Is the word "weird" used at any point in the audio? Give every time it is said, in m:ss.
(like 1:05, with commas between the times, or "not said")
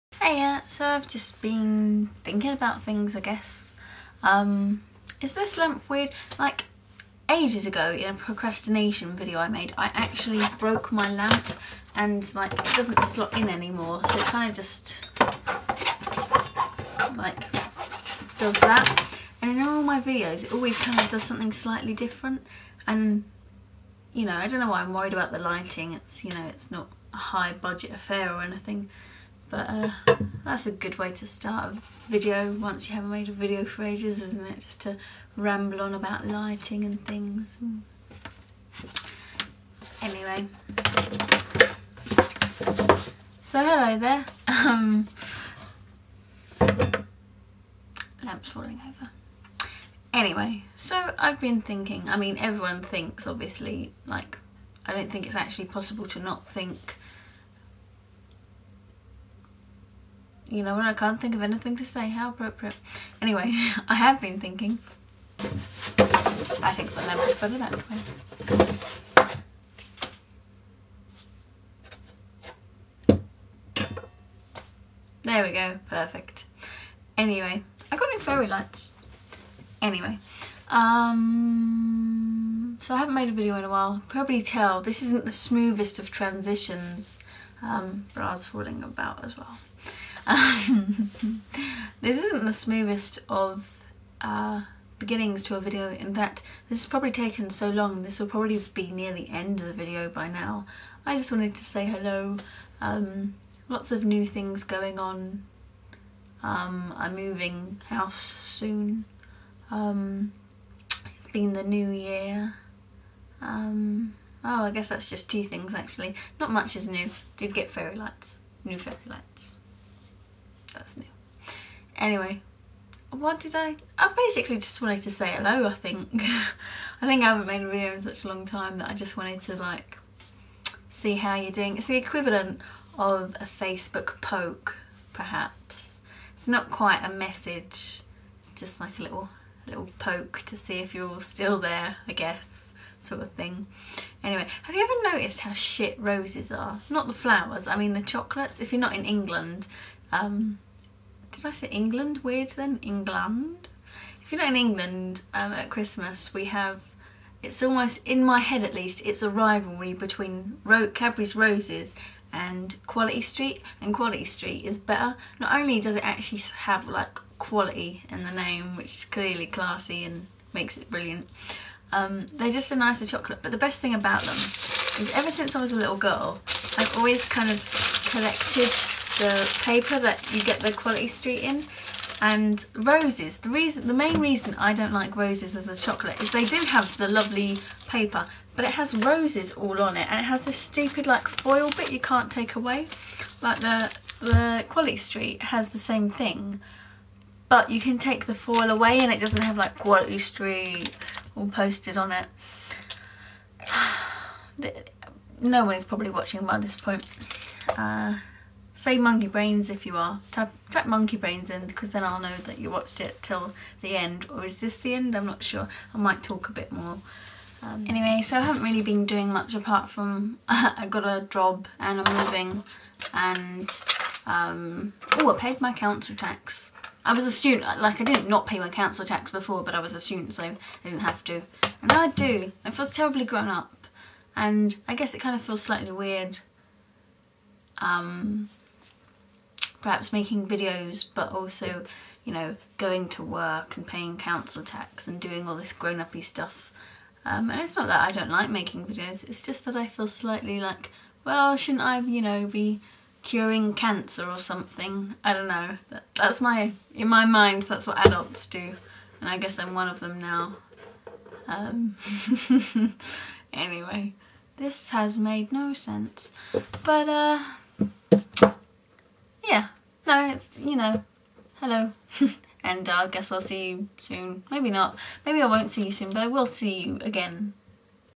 0:05, 2:32, 3:55.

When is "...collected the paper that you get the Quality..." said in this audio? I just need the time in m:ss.
2:58.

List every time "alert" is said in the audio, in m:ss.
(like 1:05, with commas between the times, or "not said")
not said.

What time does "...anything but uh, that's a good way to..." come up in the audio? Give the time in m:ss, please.
0:28.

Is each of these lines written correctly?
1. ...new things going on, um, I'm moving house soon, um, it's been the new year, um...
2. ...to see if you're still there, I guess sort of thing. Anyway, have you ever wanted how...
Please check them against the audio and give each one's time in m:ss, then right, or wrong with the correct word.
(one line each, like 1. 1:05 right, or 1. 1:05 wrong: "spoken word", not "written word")
1. 1:44 right
2. 2:20 wrong: "noticed", not "wanted".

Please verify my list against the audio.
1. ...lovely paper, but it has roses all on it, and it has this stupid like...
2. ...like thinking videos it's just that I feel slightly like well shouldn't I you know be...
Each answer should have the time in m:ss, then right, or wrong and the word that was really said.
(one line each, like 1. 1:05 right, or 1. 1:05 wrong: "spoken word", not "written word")
1. 3:07 right
2. 4:08 wrong: "making", not "thinking".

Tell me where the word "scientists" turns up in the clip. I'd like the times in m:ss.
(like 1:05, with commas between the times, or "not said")
not said.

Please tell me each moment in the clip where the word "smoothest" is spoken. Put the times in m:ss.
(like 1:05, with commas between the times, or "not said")
1:25, 1:32.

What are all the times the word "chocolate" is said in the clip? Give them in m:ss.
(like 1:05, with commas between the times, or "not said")
2:28, 2:53, 3:05.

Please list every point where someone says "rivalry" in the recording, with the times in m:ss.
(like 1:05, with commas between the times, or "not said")
2:39.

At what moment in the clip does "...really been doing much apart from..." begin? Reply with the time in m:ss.
3:38.